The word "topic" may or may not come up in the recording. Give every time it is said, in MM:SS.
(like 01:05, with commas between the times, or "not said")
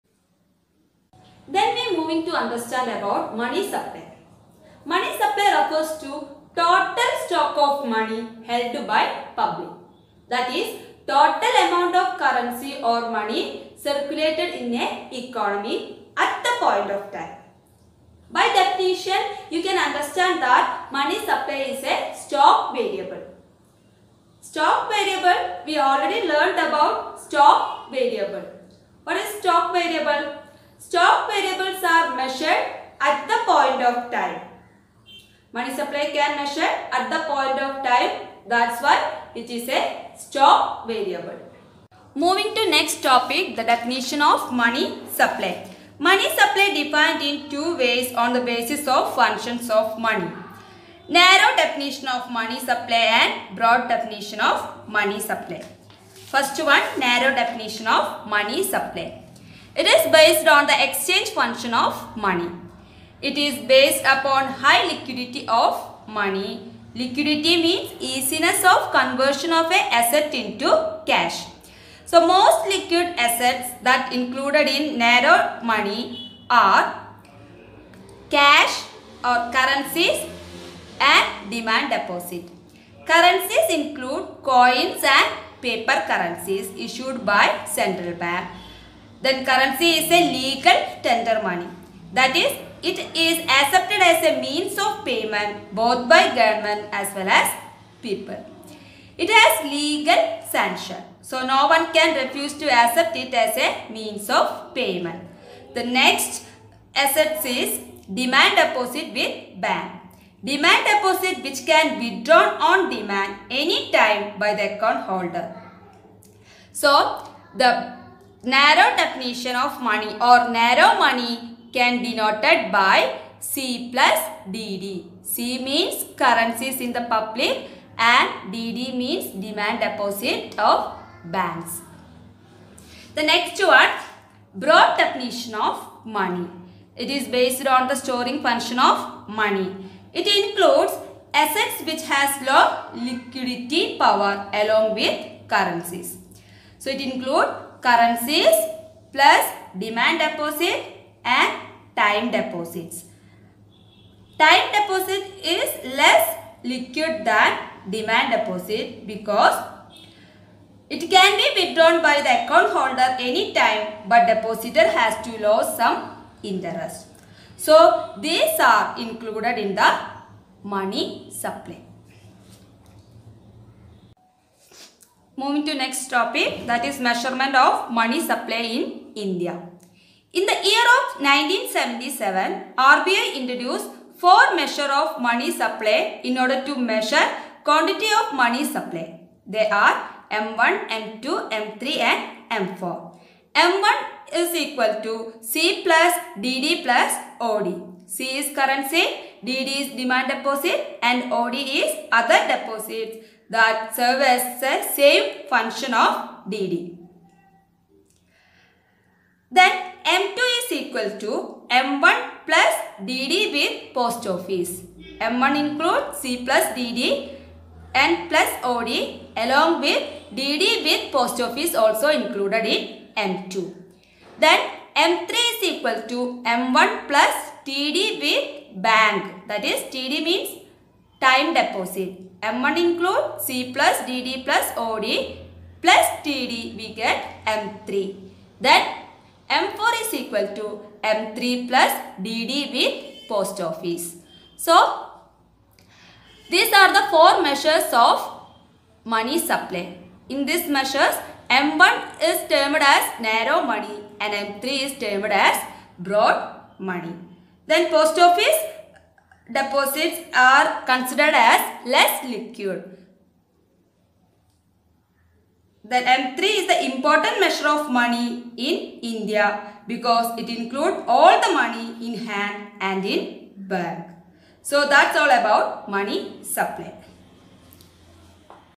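00:43, 02:56.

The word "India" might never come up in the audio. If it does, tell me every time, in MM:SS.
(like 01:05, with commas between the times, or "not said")
02:59, 04:29.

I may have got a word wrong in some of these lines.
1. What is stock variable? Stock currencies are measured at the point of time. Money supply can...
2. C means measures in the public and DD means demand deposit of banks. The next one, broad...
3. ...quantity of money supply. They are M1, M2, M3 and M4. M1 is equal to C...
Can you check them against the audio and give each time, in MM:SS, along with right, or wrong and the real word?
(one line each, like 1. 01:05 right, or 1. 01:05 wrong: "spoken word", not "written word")
1. 00:29 wrong: "variables", not "currencies"
2. 02:05 wrong: "currencies", not "measures"
3. 03:07 right.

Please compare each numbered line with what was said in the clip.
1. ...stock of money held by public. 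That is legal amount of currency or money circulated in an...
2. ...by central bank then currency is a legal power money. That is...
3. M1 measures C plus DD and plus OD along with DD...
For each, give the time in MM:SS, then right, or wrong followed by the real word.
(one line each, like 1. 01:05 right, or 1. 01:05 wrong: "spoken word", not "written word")
1. 00:07 wrong: "total", not "legal"
2. 01:27 wrong: "tender", not "power"
3. 03:35 wrong: "includes", not "measures".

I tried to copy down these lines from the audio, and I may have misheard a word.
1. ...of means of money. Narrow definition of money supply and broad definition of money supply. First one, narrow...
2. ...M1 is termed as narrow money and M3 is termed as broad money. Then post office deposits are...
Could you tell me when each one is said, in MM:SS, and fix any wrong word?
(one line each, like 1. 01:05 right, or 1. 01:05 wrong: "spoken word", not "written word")
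1. 00:48 wrong: "functions", not "means"
2. 04:11 right.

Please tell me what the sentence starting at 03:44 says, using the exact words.
Then M3 is equal to M1 plus TD with bank.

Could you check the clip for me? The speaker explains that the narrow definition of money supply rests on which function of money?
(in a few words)
Exchange function.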